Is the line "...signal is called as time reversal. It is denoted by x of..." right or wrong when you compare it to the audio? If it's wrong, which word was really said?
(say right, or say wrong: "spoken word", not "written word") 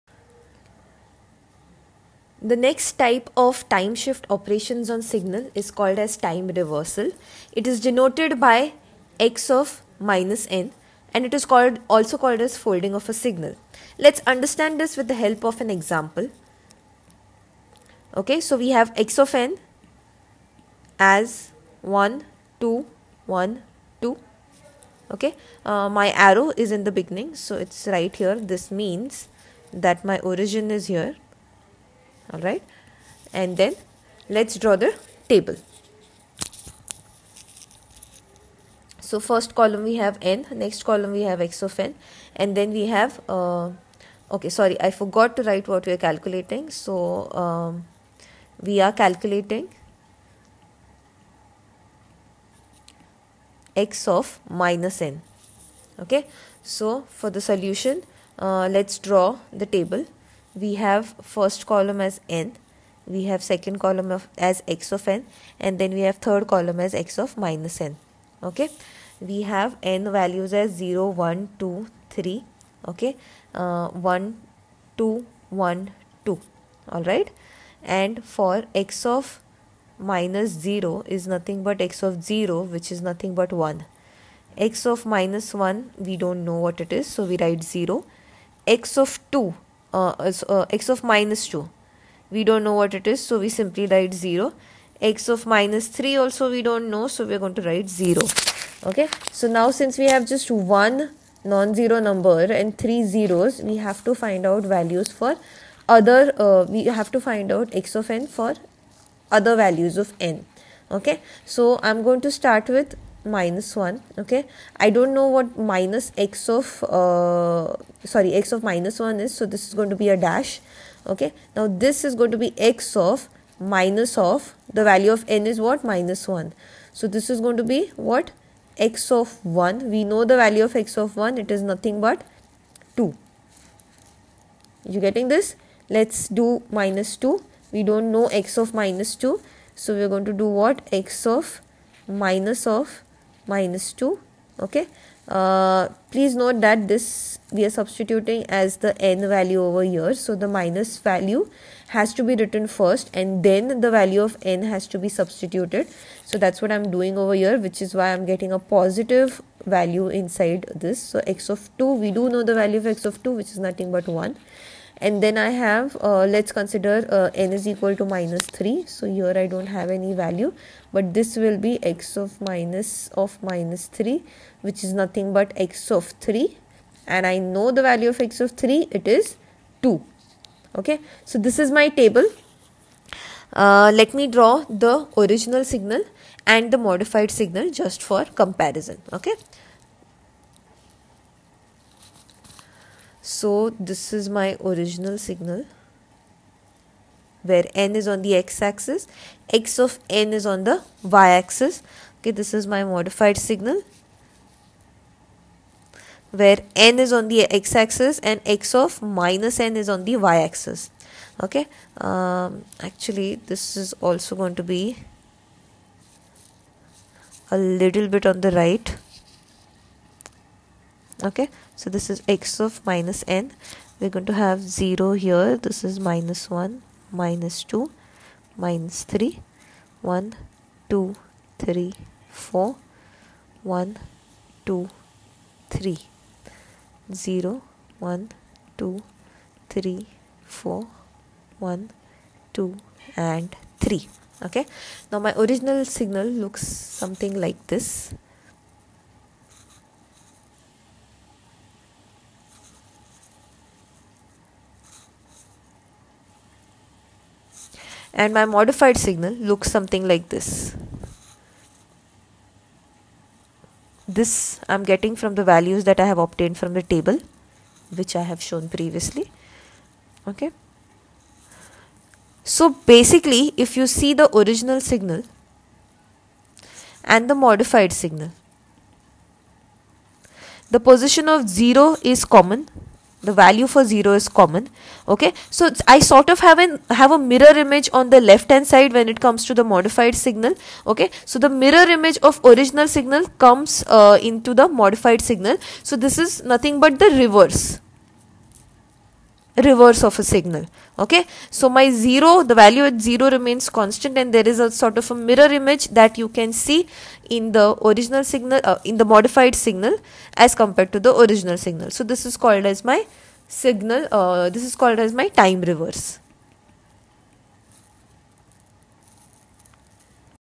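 right.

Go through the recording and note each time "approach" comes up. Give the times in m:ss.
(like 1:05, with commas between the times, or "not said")
not said.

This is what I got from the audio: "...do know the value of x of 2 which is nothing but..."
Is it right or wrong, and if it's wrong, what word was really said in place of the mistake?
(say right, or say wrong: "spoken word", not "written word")
right.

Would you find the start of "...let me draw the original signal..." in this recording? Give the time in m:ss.
3:04.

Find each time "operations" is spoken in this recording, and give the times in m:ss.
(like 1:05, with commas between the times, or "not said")
0:04.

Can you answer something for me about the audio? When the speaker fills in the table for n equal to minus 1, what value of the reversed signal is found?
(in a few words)
2.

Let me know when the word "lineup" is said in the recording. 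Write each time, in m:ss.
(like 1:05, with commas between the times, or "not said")
not said.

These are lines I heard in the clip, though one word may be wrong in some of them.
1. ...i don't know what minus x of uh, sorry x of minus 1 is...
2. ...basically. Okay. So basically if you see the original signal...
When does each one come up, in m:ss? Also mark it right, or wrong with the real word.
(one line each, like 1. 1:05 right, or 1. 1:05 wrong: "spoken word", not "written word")
1. 1:54 right
2. 4:28 wrong: "previously", not "basically".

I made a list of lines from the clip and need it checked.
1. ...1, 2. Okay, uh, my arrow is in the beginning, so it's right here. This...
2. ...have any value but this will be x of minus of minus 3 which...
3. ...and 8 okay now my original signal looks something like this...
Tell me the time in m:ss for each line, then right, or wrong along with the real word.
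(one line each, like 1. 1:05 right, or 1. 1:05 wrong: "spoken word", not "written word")
1. 0:23 right
2. 2:49 right
3. 4:03 wrong: "3", not "8".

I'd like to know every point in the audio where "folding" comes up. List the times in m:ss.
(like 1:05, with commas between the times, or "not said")
0:12.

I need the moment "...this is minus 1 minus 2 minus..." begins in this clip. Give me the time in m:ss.
3:45.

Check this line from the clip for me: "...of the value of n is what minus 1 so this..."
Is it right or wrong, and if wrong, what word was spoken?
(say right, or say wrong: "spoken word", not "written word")
right.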